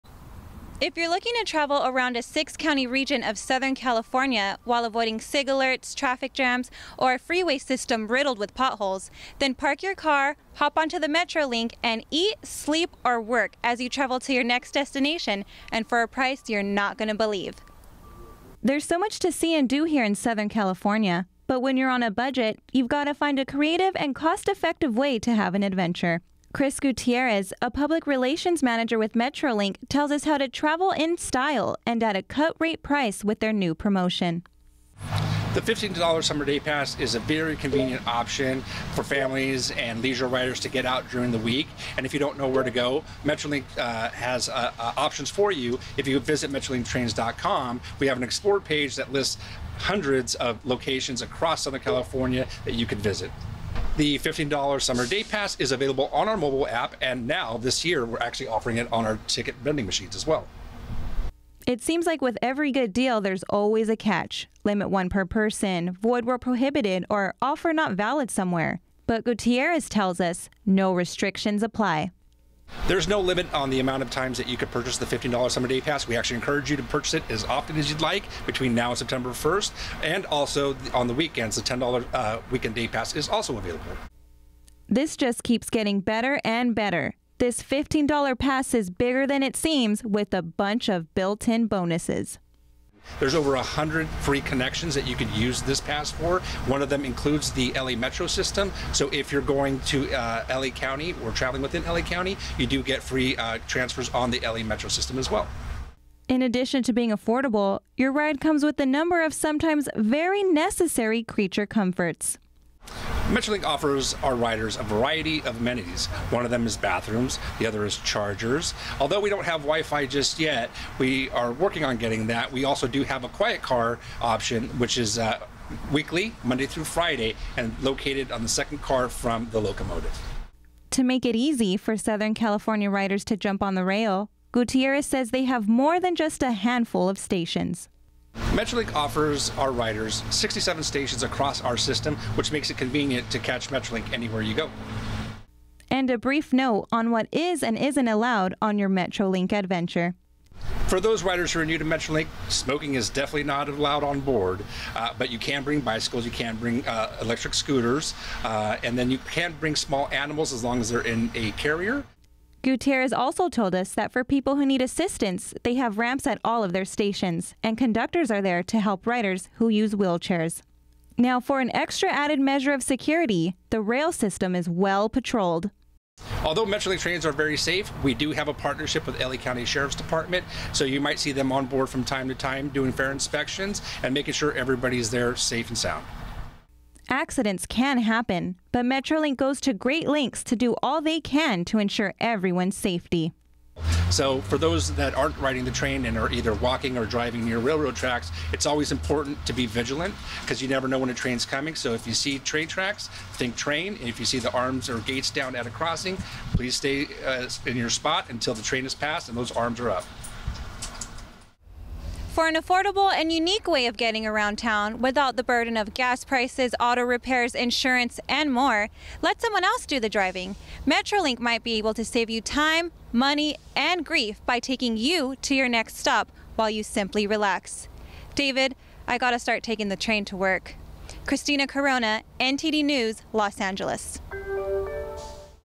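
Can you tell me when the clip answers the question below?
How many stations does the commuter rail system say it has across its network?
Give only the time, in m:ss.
2:20.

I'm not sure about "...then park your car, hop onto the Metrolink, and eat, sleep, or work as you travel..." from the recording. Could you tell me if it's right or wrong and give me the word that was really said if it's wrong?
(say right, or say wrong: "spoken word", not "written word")
right.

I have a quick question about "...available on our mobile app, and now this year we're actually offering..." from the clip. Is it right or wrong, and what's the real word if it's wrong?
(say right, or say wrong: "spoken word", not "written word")
right.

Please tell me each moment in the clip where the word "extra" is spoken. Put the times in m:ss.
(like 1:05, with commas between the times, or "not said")
2:51.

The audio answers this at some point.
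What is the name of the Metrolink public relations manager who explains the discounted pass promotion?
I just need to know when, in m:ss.
0:26.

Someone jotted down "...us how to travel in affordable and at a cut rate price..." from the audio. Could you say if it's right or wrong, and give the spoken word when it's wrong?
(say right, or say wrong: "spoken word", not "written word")
wrong: "style", not "affordable".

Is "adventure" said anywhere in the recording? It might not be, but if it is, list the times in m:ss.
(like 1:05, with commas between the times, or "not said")
0:25, 2:29.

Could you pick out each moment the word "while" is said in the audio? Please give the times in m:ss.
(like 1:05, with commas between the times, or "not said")
0:04, 3:46.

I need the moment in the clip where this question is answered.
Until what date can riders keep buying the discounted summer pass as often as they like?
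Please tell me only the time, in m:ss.
1:18.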